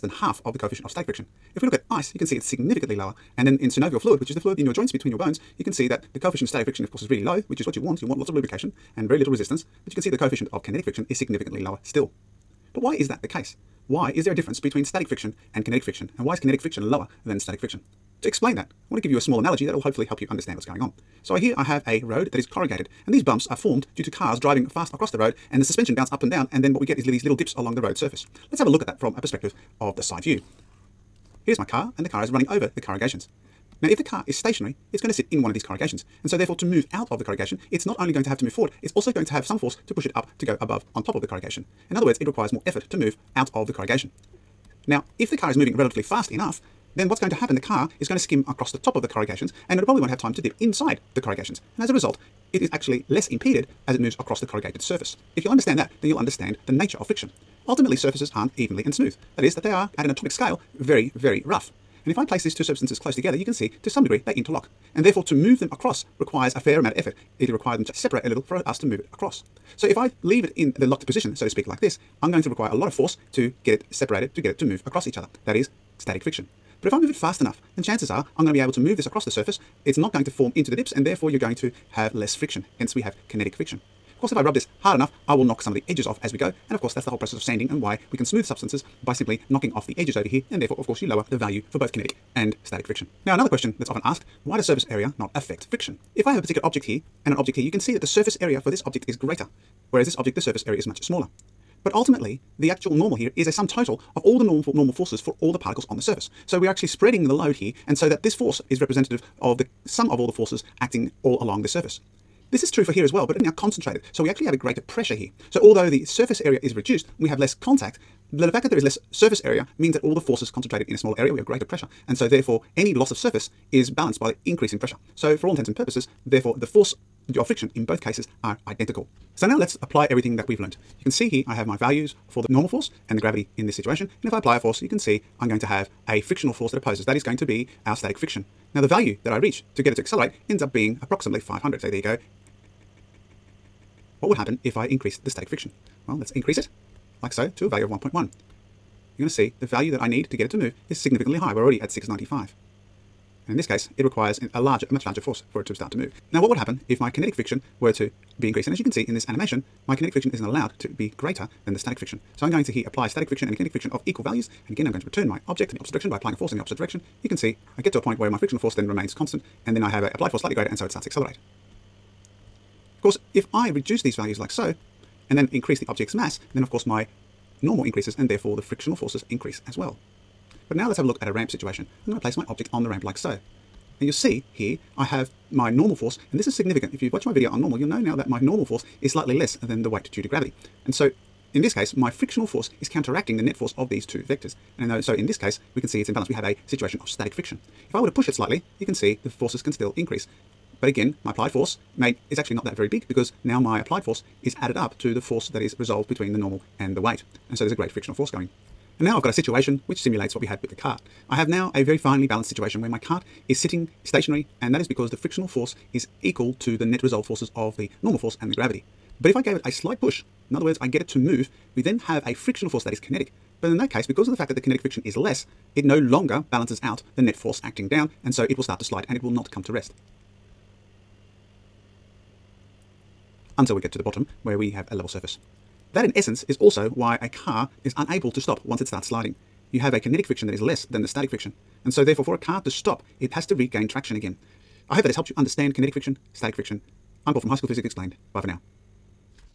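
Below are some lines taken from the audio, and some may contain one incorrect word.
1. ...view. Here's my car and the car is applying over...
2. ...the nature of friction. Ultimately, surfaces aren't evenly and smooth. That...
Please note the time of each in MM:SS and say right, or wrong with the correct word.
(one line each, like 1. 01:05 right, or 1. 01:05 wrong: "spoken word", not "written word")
1. 00:30 wrong: "running", not "applying"
2. 00:56 right.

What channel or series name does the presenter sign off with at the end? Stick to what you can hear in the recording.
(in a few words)
High School Physics Explained.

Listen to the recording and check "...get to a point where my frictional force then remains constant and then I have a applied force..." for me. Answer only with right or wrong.
right.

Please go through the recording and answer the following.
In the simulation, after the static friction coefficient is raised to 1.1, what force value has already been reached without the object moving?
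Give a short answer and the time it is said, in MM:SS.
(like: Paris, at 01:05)
695, at 02:31.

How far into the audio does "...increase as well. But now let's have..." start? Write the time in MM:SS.
02:59.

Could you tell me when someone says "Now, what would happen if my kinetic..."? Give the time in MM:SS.
02:36.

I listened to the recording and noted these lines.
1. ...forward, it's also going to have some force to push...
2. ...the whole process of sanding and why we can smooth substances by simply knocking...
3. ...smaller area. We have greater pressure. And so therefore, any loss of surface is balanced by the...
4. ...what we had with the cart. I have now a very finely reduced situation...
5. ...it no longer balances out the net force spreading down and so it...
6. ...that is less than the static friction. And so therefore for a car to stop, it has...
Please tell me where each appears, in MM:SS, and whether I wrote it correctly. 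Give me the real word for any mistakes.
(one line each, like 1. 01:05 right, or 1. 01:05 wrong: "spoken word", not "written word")
1. 00:38 right
2. 01:27 right
3. 02:00 right
4. 03:30 wrong: "balanced", not "reduced"
5. 03:45 wrong: "acting", not "spreading"
6. 04:00 right.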